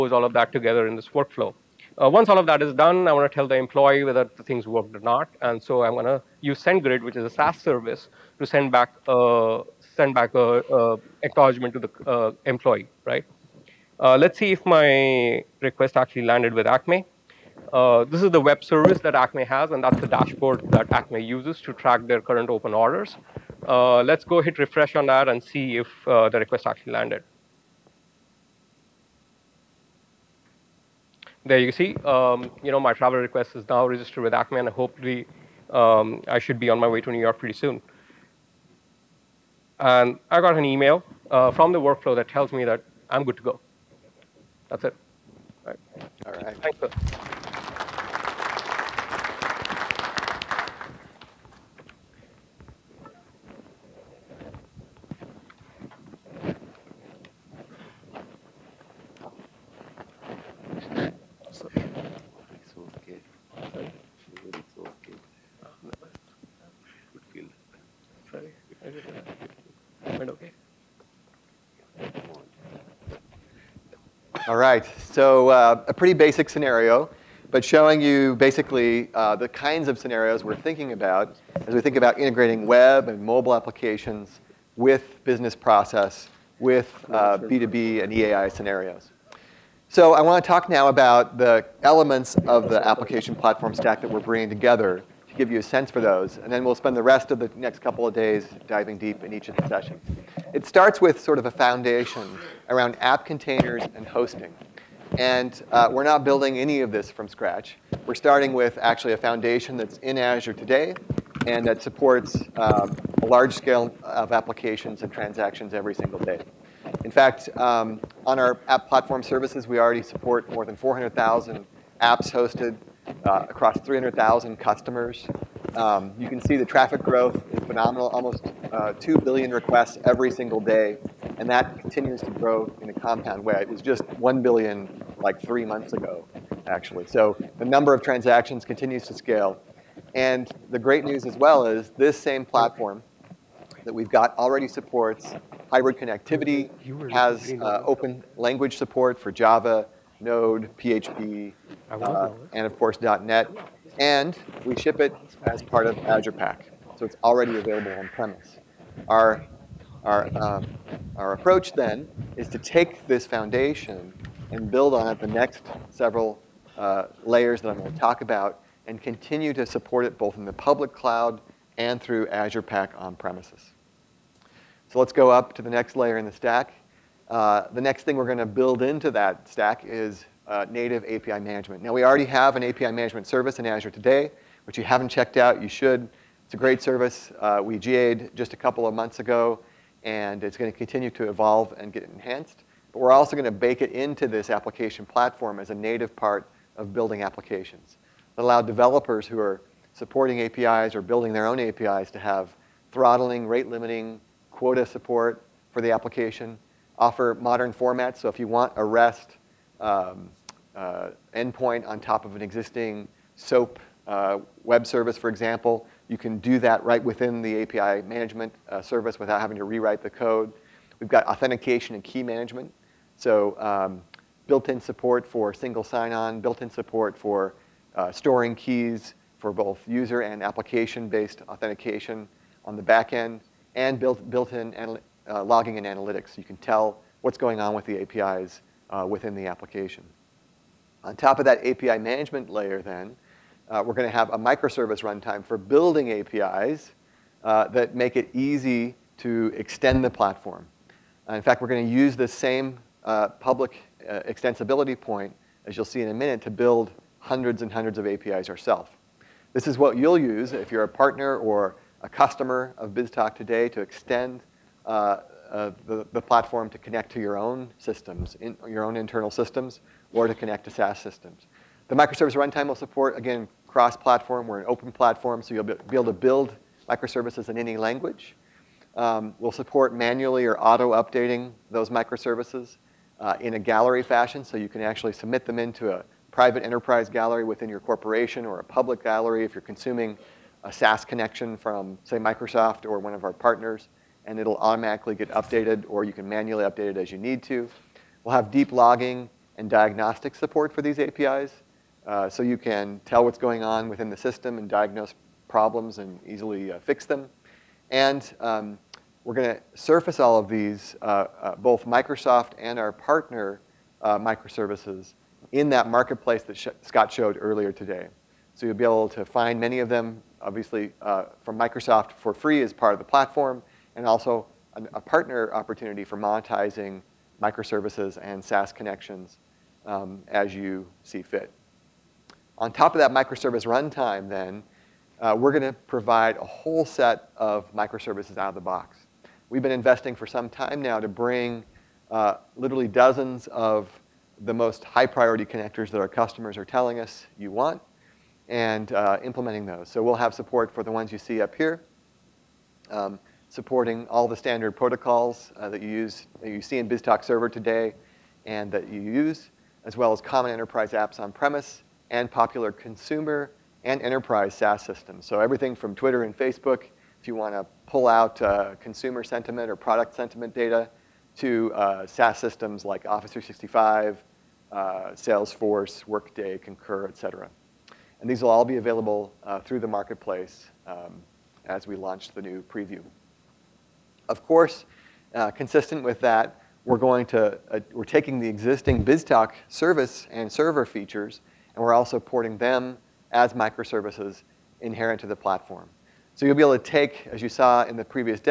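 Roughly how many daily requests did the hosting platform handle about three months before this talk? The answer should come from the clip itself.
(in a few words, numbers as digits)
1 billion.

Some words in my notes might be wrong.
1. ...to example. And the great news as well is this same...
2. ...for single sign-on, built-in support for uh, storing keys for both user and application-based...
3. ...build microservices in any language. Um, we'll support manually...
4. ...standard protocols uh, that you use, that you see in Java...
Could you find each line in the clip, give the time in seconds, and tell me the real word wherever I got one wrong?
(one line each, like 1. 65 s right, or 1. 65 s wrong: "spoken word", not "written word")
1. 139 s wrong: "scale", not "example"
2. 225 s right
3. 276 s right
4. 354 s wrong: "BizTalk", not "Java".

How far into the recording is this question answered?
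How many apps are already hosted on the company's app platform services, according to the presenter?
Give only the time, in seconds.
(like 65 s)
120 s.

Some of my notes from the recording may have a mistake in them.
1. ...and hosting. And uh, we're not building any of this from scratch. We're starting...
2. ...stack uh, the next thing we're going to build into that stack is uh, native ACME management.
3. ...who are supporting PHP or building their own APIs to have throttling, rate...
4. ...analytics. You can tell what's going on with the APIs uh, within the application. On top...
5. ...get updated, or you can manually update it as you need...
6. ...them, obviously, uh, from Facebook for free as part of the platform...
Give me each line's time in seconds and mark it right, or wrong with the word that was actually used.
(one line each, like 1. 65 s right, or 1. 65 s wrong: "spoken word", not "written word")
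1. 103 s right
2. 176 s wrong: "API", not "ACME"
3. 199 s wrong: "APIs", not "PHP"
4. 235 s right
5. 295 s right
6. 319 s wrong: "Microsoft", not "Facebook".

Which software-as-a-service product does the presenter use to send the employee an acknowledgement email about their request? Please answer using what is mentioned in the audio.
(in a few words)
SendGrid.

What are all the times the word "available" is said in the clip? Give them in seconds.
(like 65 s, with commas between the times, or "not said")
157 s, 378 s.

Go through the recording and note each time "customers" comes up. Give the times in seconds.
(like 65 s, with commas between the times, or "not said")
124 s, 262 s, 346 s.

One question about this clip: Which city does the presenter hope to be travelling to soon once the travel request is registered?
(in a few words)
New York.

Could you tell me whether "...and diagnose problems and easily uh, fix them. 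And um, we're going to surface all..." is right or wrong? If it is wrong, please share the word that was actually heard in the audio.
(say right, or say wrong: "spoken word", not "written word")
right.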